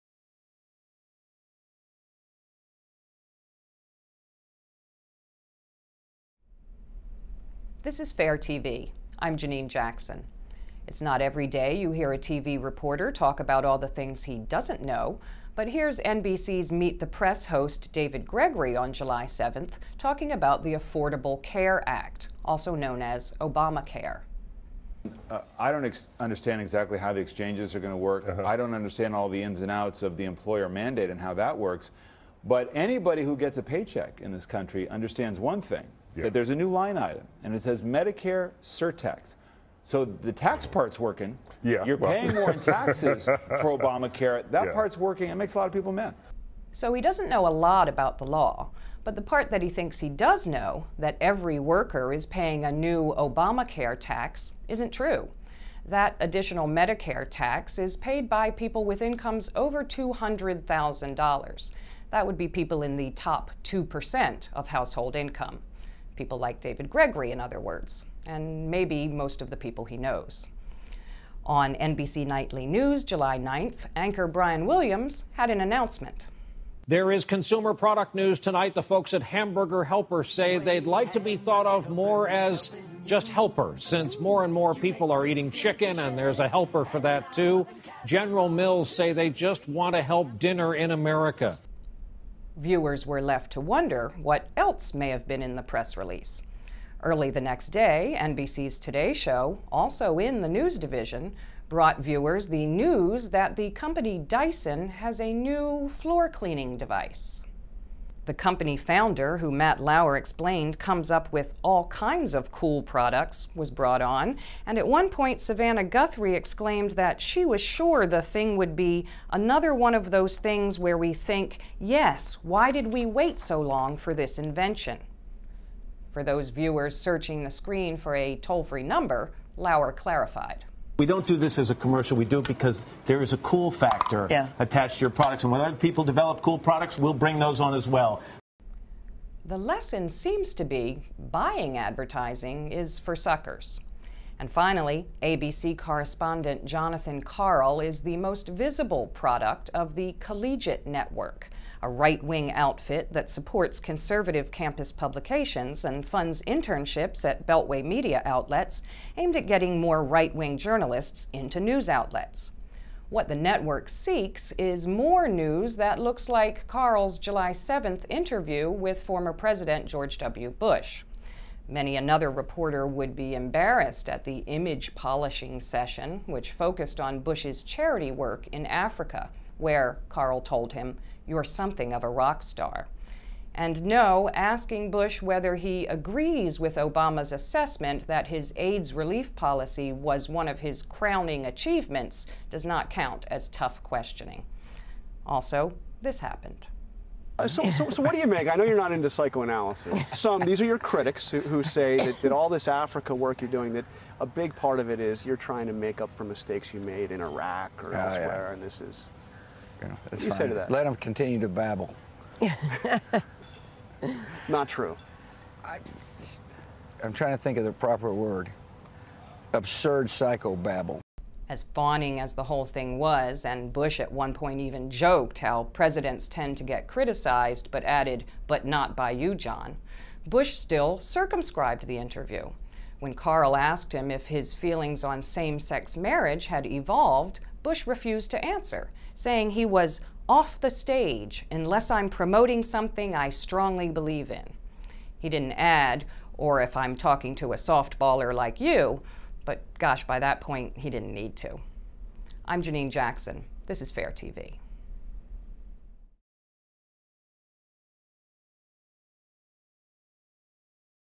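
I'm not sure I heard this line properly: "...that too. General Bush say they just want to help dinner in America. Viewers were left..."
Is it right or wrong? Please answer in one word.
wrong.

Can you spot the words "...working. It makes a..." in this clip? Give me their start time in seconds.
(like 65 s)
44 s.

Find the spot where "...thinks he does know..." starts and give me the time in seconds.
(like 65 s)
49 s.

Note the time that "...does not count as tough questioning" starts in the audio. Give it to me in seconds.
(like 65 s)
192 s.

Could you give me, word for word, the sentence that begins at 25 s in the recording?
Uh, I don't ex understand exactly how the exchanges are going to work.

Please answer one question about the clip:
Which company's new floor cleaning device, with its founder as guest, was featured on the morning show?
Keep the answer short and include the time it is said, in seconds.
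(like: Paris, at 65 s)
Dyson, at 104 s.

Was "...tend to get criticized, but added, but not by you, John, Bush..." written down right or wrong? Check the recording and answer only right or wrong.
right.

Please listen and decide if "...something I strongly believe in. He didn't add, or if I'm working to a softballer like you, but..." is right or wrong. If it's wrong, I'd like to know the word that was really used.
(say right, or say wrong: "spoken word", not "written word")
wrong: "talking", not "working".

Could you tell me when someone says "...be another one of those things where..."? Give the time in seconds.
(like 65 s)
118 s.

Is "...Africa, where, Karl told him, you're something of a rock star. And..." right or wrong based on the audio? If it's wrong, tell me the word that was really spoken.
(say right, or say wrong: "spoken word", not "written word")
right.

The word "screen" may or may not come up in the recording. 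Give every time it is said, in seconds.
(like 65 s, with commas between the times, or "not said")
127 s.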